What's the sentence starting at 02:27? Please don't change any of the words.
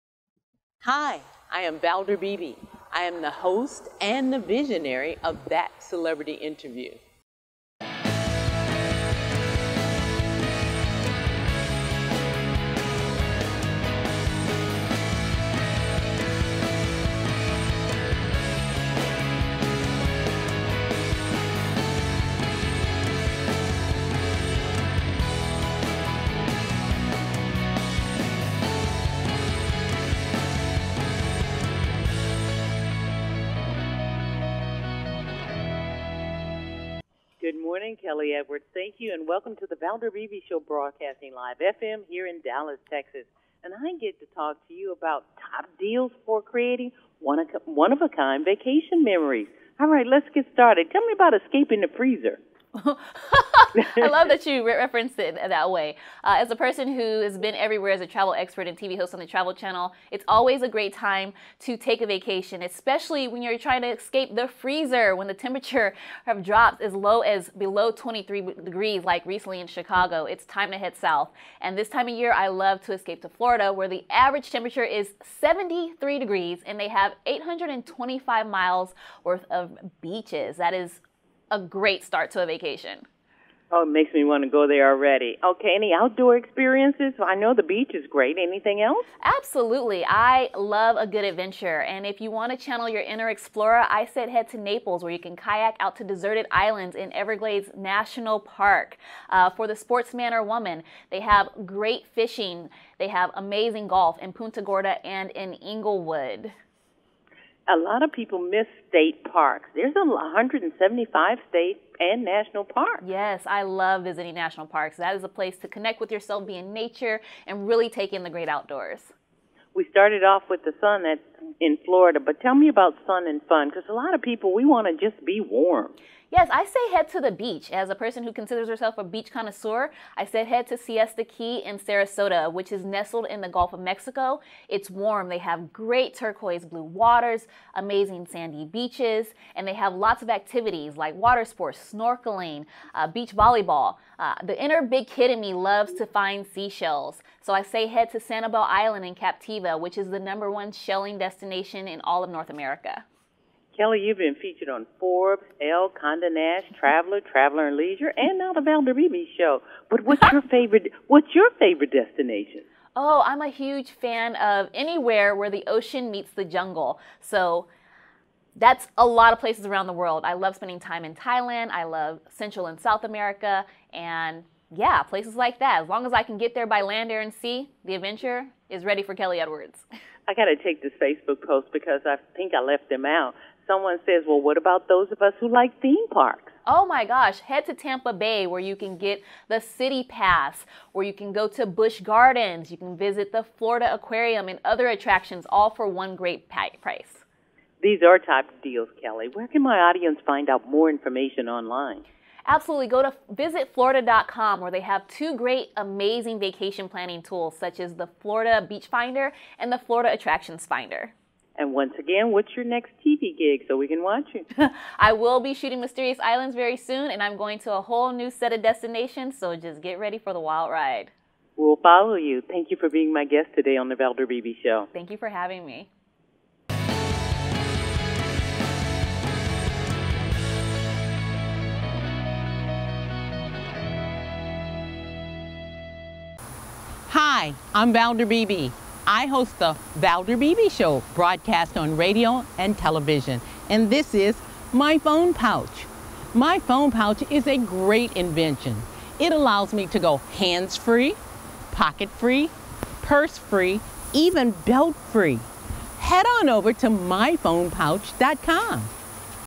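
So I say head to Sanibel Island in Captiva, which is the number one shelling destination destination in all of North America.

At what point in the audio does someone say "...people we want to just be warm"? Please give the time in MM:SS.
02:04.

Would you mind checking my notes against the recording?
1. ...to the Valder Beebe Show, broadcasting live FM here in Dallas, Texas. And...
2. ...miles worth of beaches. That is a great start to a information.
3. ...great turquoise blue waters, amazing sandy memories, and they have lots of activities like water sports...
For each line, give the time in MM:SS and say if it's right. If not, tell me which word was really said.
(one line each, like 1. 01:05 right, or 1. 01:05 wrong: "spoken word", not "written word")
1. 00:39 right
2. 01:18 wrong: "vacation", not "information"
3. 02:15 wrong: "beaches", not "memories".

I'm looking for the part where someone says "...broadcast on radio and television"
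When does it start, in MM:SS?
04:01.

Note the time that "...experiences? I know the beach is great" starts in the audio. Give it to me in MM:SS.
01:26.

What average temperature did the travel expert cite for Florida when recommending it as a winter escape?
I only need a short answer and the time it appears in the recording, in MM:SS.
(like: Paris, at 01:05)
73 degrees, at 01:15.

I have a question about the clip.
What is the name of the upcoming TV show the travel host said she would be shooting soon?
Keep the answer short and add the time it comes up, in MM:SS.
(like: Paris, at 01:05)
Mysterious Islands, at 03:35.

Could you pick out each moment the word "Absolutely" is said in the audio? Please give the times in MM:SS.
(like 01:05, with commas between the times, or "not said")
01:29, 03:22.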